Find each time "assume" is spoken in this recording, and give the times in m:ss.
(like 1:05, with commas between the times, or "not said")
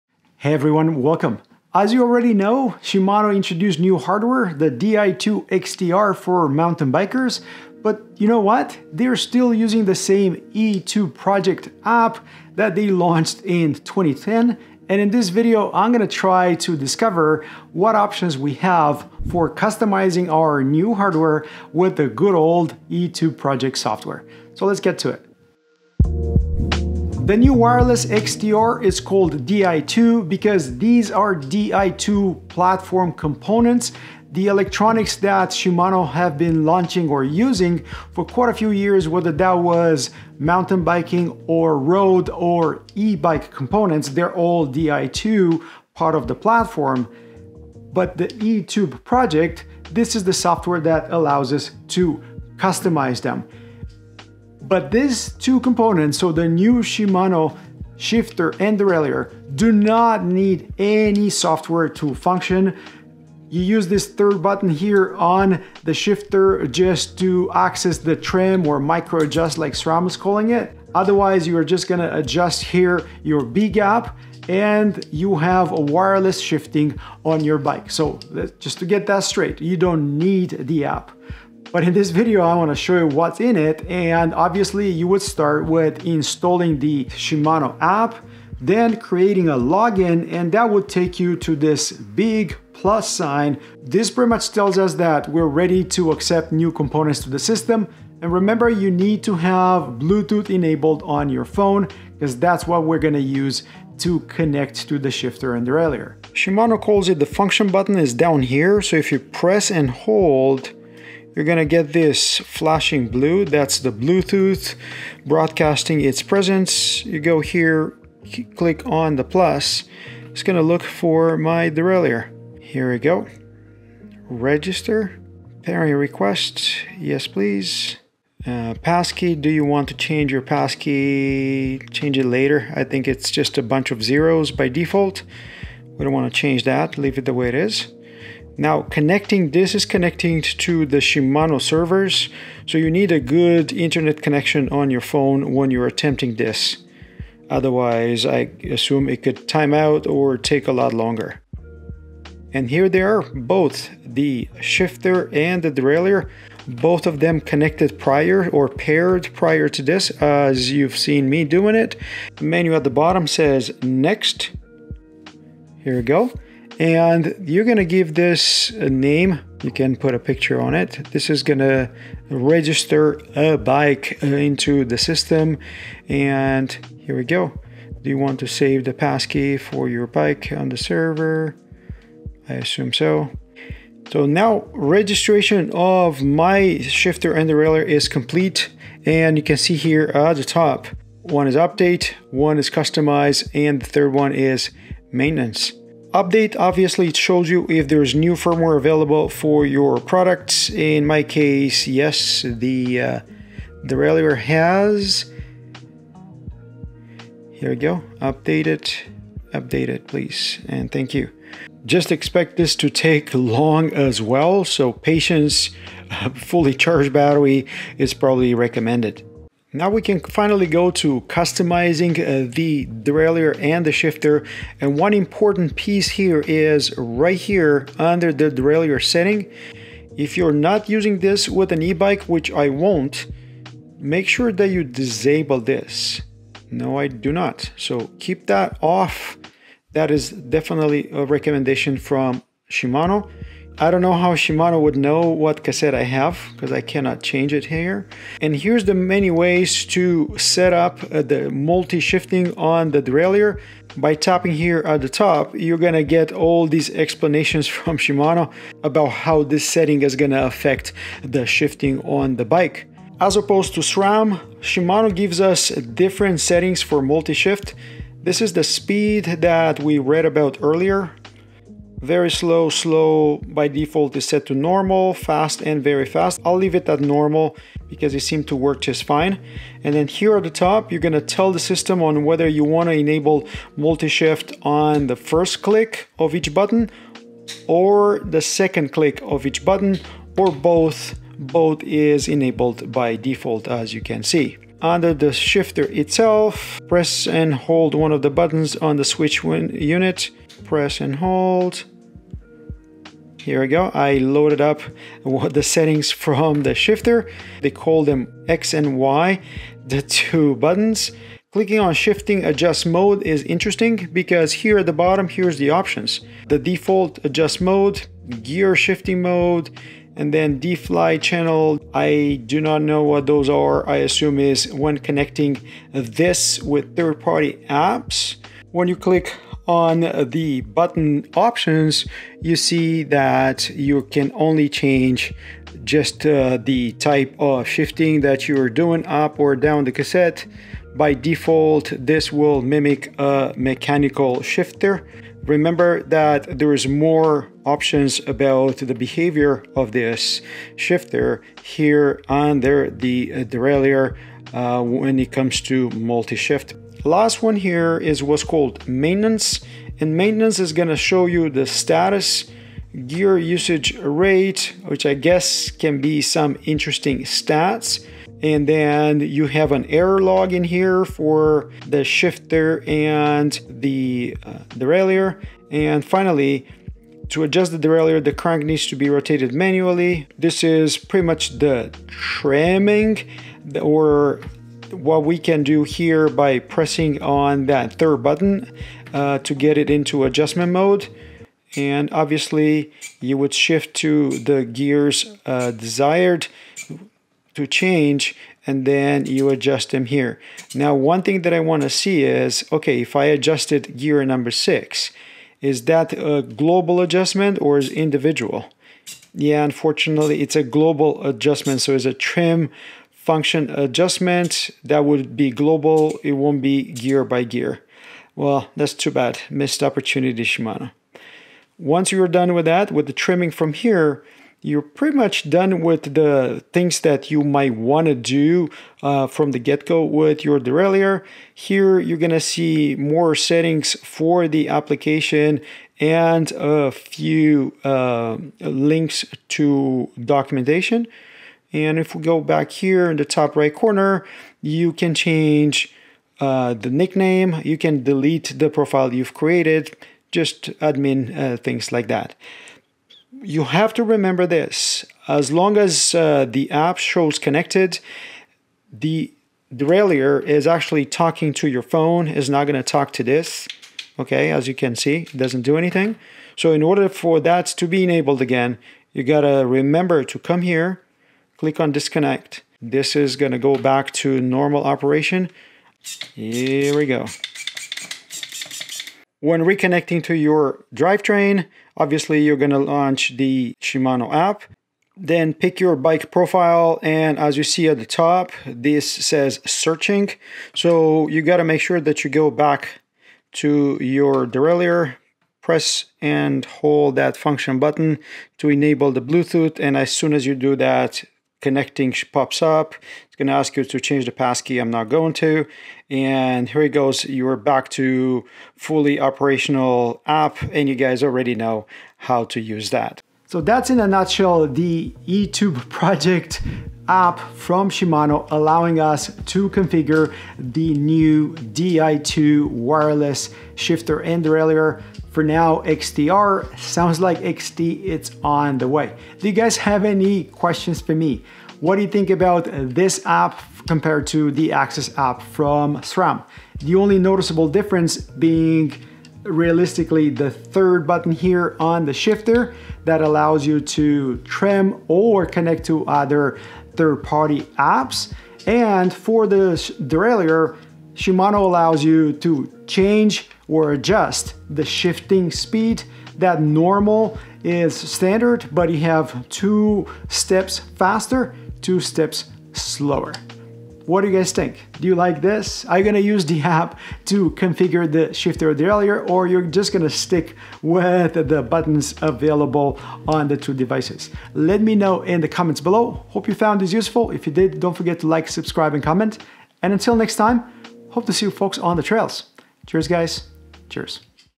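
2:28, 3:02, 5:23.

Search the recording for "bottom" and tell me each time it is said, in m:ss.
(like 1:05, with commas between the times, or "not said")
2:42, 5:14.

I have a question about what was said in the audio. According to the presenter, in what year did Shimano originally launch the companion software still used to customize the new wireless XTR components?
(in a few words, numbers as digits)
2010.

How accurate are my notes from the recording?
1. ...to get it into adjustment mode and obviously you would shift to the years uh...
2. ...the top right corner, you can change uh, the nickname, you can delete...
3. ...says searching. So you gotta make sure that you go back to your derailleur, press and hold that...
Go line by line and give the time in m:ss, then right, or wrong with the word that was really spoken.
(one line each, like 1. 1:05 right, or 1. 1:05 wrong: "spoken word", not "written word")
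1. 6:29 wrong: "gears", not "years"
2. 7:23 right
3. 8:09 right.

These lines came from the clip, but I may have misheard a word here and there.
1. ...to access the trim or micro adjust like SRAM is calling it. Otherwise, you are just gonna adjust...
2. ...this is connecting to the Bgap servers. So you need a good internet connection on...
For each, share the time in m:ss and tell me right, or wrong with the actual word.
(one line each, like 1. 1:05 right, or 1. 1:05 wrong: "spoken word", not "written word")
1. 1:07 right
2. 2:19 wrong: "Shimano", not "Bgap".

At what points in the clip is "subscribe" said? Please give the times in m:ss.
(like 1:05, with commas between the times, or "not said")
9:38.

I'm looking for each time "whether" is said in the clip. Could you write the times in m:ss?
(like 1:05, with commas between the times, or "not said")
0:39, 4:42.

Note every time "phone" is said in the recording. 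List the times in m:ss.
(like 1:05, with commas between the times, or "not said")
1:41, 2:25, 7:41.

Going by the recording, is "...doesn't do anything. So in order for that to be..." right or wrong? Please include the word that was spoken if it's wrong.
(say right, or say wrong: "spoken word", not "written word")
right.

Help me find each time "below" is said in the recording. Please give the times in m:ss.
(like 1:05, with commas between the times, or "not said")
9:35.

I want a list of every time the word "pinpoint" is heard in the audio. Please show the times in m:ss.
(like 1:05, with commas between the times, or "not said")
not said.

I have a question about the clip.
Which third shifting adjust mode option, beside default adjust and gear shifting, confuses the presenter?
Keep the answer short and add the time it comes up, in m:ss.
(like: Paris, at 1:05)
D-Fly channel, at 5:20.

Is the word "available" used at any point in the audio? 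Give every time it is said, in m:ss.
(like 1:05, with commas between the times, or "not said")
3:18, 9:32.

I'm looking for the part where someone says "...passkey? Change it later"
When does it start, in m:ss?
2:10.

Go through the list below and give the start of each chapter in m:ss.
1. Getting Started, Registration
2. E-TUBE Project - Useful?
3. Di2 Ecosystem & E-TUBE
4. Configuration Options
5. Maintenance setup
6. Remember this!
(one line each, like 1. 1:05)
1. 1:22
2. 8:33
3. 0:27
4. 3:00
5. 5:57
6. 7:35.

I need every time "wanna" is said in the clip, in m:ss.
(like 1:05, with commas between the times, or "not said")
1:22, 4:42.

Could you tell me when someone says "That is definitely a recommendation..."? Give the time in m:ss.
3:59.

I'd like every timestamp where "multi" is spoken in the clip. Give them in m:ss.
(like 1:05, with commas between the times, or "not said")
4:11, 4:27, 4:43, 5:55.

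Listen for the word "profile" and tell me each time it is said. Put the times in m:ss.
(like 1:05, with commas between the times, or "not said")
7:28, 8:06.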